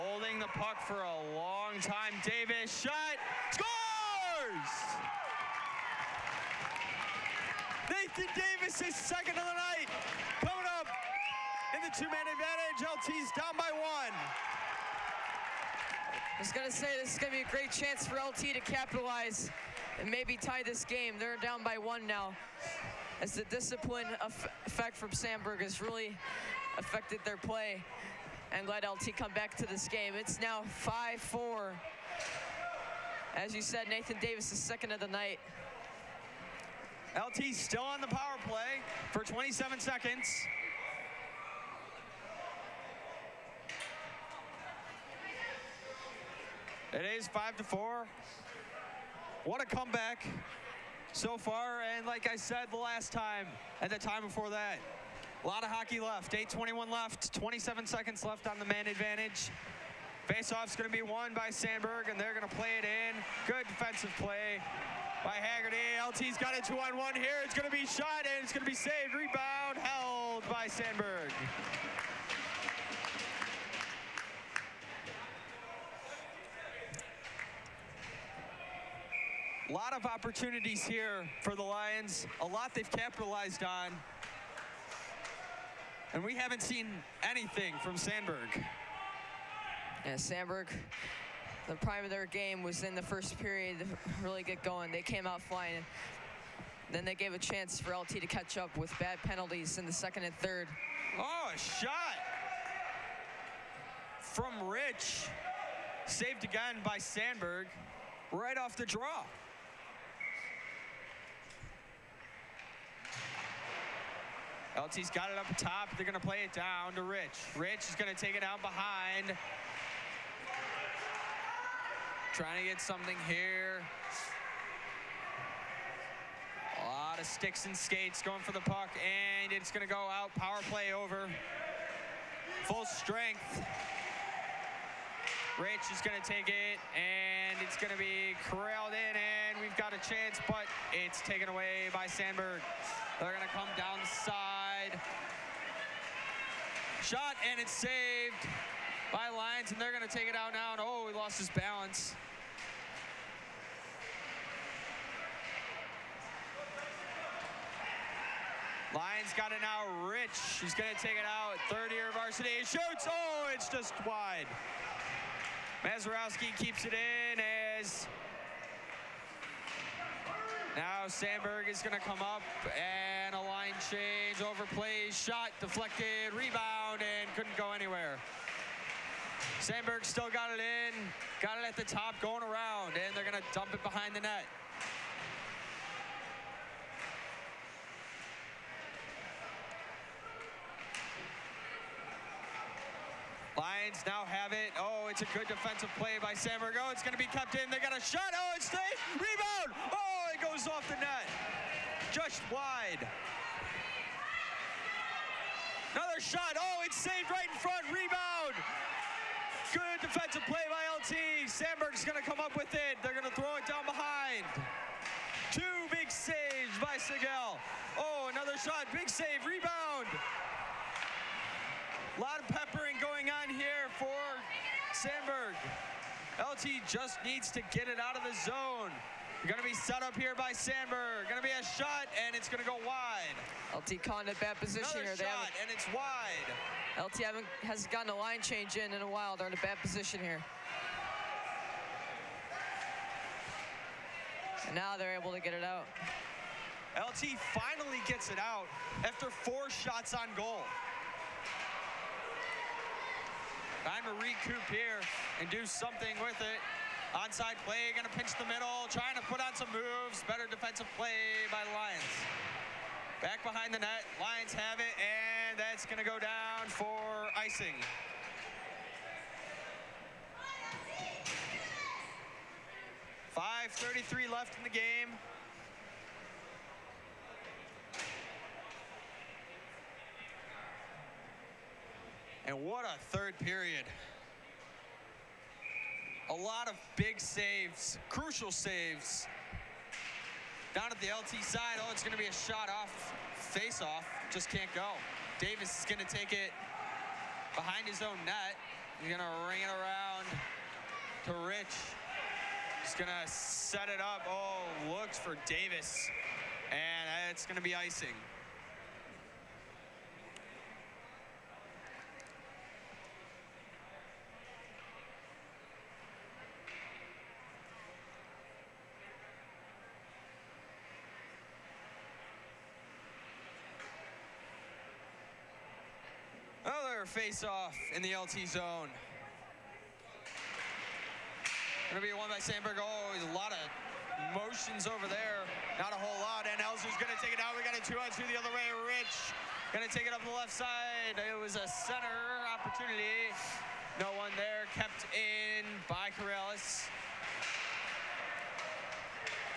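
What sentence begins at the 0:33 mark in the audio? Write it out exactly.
As you said, Nathan Davis is second of the night.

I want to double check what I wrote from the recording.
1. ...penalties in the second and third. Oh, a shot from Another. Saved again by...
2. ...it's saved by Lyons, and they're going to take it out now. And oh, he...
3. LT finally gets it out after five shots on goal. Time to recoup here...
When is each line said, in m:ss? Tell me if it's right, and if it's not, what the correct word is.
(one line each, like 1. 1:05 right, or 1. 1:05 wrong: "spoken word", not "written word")
1. 1:39 wrong: "Rich", not "Another"
2. 2:27 right
3. 4:06 wrong: "four", not "five".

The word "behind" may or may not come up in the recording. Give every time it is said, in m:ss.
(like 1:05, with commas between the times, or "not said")
1:58, 3:03, 3:33, 4:23, 4:57.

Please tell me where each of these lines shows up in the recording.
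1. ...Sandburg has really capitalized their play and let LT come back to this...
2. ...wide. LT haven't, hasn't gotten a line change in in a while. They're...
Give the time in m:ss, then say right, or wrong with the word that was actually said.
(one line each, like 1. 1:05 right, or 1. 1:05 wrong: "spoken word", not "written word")
1. 0:25 wrong: "affected", not "capitalized"
2. 3:55 right.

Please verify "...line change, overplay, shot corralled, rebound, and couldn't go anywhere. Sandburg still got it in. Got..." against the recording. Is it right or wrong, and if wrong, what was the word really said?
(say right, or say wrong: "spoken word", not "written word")
wrong: "deflected", not "corralled".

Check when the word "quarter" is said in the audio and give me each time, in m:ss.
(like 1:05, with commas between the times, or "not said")
not said.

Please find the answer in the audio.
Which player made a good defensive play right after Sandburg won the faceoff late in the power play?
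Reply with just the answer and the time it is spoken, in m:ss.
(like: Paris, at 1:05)
Haggerty, at 1:05.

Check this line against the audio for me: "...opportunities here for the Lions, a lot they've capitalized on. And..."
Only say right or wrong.
right.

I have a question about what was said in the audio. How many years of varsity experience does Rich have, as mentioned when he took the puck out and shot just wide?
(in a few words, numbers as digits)
Third year.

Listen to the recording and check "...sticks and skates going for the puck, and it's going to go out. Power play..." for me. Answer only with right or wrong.
right.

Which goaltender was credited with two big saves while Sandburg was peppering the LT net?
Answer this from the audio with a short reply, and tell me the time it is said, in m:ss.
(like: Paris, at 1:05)
Sigel, at 3:36.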